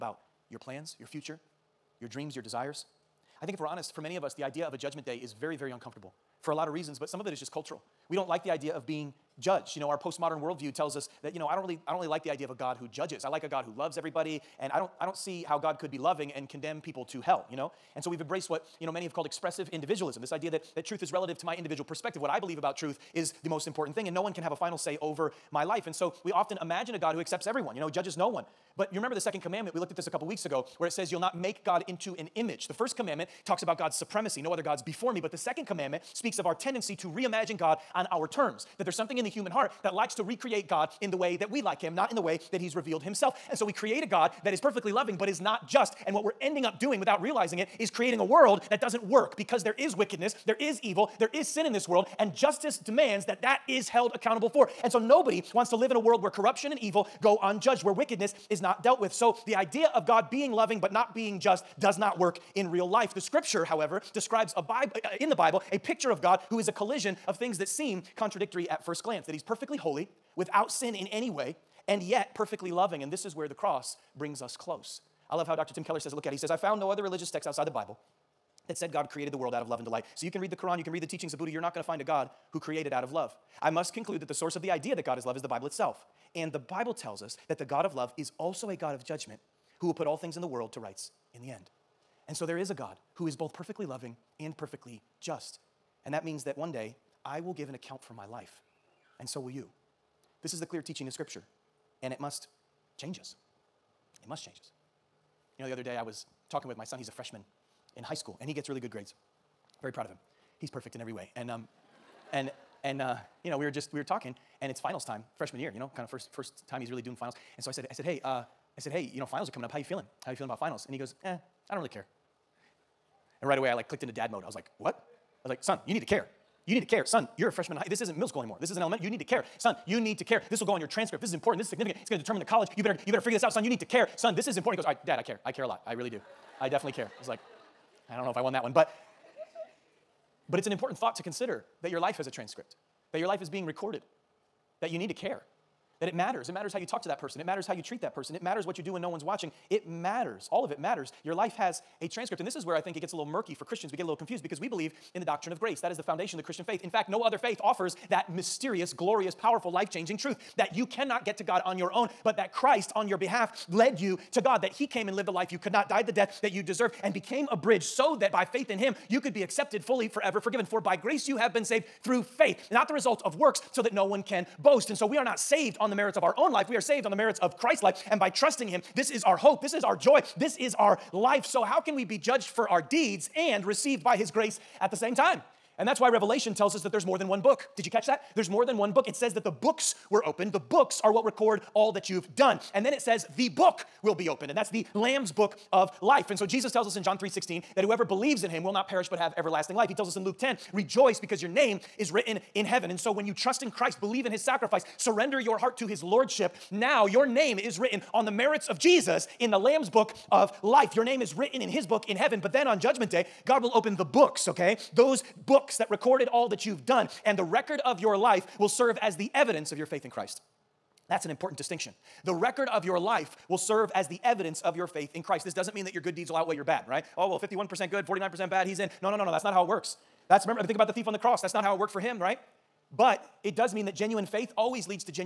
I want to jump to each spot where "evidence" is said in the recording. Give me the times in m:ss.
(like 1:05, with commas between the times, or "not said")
3:39, 3:44.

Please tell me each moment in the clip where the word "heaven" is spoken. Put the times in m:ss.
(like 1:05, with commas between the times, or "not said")
3:22, 3:32.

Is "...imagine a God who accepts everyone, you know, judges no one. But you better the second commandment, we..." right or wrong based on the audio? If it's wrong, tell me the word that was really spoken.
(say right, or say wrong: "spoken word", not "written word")
wrong: "remember", not "better".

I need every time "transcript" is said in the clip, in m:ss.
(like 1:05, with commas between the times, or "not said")
2:10, 2:22, 2:32.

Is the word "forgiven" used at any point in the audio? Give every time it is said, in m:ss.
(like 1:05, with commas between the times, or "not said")
2:50.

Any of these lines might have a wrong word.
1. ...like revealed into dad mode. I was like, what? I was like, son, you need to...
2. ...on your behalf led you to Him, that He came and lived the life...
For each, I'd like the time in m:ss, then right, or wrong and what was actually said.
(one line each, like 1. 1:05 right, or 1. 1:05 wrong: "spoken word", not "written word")
1. 2:03 wrong: "clicked", not "revealed"
2. 2:42 wrong: "God", not "Him".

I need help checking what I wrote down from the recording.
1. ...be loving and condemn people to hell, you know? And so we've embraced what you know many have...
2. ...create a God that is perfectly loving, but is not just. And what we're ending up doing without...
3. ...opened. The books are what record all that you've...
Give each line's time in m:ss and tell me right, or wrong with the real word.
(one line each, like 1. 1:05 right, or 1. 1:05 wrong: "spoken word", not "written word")
1. 0:15 right
2. 0:43 right
3. 3:10 right.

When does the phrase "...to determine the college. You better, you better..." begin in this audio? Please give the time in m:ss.
2:12.